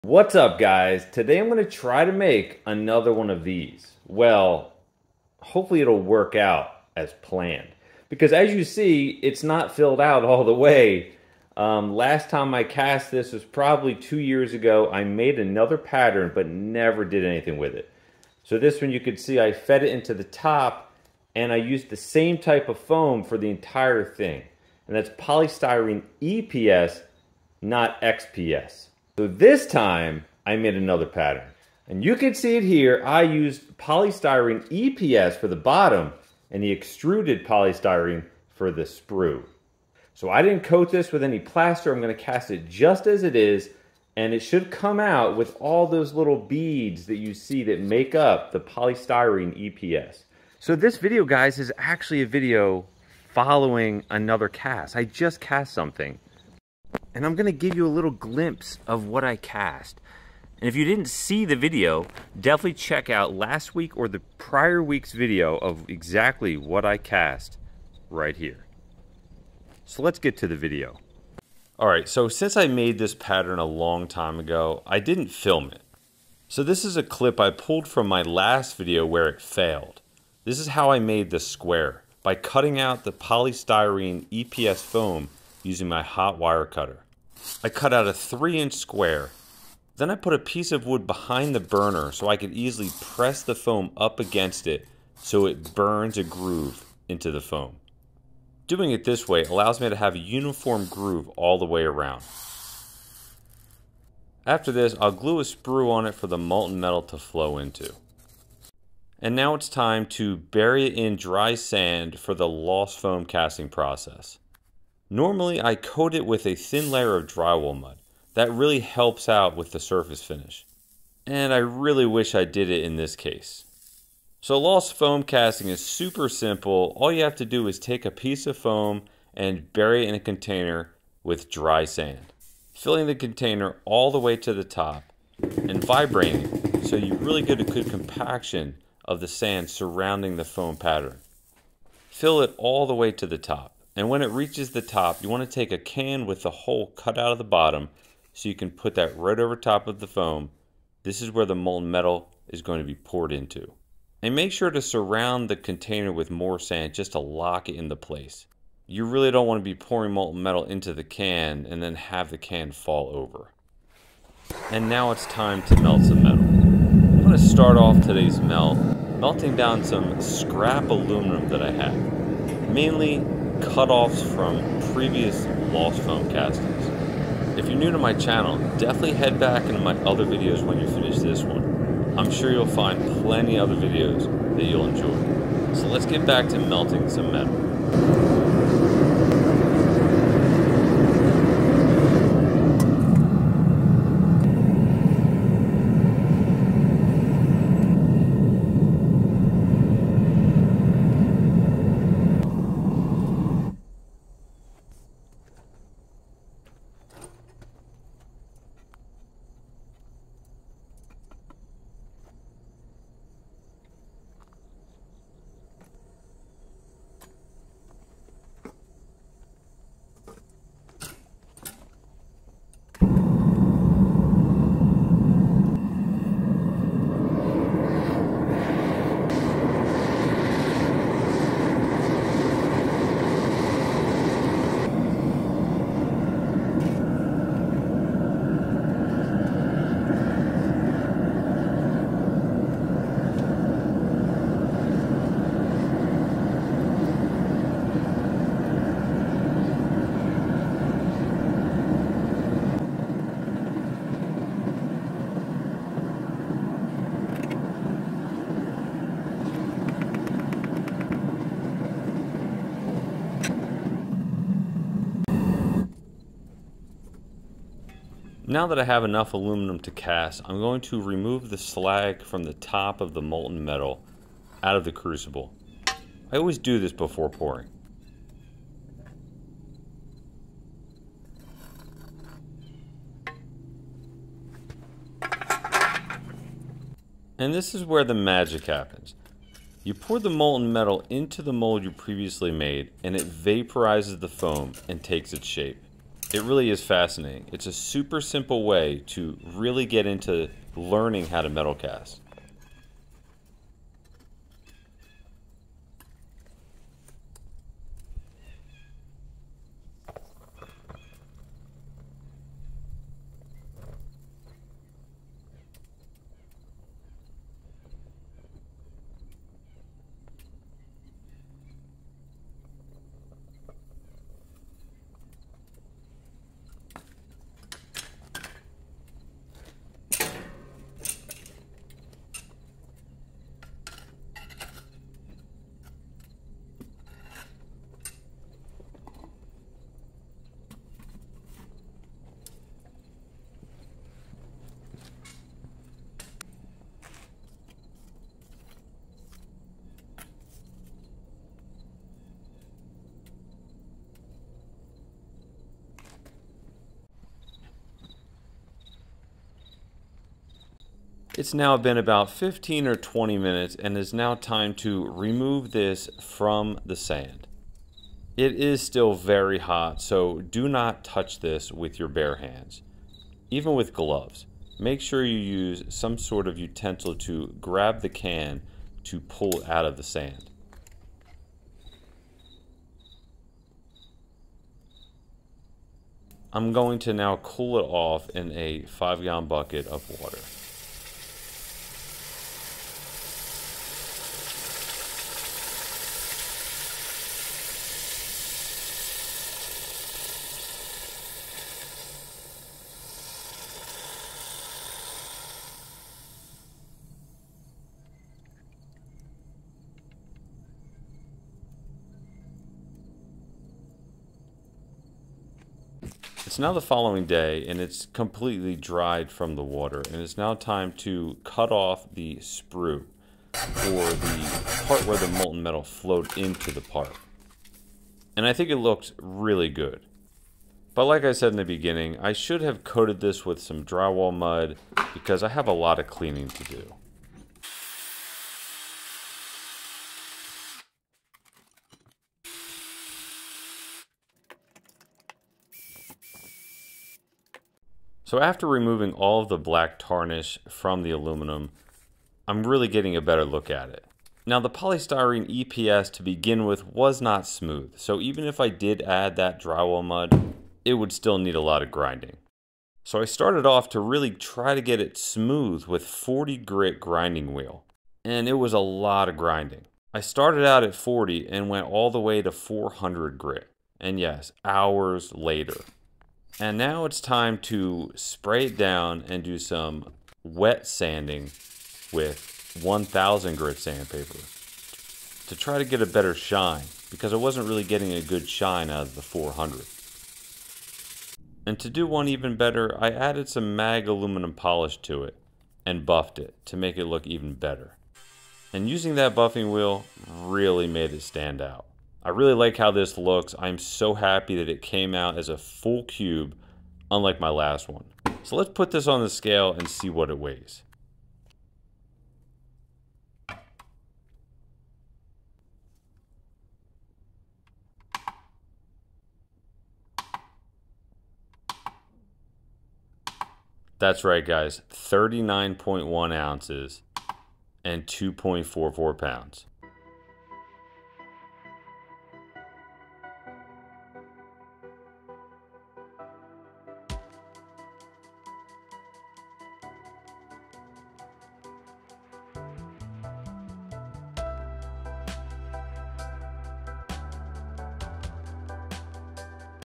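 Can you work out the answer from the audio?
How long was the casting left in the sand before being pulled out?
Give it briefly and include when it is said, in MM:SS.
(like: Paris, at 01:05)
15 or 20 minutes, at 06:02.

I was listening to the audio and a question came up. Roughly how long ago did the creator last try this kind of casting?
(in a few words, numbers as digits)
2 years ago.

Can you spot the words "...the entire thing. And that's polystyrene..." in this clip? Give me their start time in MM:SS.
00:23.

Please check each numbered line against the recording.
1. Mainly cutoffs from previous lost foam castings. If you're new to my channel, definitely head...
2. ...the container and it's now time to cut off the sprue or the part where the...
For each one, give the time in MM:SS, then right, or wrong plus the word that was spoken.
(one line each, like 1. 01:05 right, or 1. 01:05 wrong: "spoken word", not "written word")
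1. 02:52 right
2. 06:59 wrong: "water", not "container".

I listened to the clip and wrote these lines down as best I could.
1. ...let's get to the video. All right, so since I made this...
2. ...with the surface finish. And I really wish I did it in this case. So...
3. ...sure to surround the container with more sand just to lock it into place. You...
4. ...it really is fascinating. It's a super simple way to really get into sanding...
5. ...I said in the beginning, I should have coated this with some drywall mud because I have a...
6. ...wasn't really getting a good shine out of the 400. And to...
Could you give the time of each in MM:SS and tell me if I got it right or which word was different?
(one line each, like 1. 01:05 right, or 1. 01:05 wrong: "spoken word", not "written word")
1. 01:10 right
2. 01:59 right
3. 02:34 right
4. 04:56 wrong: "learning", not "sanding"
5. 07:11 right
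6. 08:07 right.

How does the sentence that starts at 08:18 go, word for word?
And using that buffing wheel really made it stand out.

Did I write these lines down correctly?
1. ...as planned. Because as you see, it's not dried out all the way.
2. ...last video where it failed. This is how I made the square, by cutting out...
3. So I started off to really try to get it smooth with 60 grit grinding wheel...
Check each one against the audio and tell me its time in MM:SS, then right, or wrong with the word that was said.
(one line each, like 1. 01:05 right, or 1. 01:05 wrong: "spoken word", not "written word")
1. 00:06 wrong: "filled", not "dried"
2. 01:18 right
3. 07:43 wrong: "40", not "60".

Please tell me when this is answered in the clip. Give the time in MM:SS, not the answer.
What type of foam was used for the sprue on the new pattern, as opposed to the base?
00:36.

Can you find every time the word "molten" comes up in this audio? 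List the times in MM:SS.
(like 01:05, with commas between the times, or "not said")
01:46, 02:31, 02:40, 04:33, 04:50, 07:05.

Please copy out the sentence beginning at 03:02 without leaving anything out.
I'm sure you'll find plenty other videos that you'll enjoy.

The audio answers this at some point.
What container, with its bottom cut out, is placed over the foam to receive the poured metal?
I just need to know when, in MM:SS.
02:25.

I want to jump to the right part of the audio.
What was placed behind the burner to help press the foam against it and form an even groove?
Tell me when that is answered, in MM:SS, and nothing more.
01:30.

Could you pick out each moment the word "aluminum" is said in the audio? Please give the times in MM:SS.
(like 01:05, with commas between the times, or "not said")
02:50, 04:29, 07:31, 08:14.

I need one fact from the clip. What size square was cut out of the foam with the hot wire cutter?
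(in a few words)
3 inch.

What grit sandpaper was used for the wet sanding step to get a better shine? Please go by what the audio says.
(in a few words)
1000 grit.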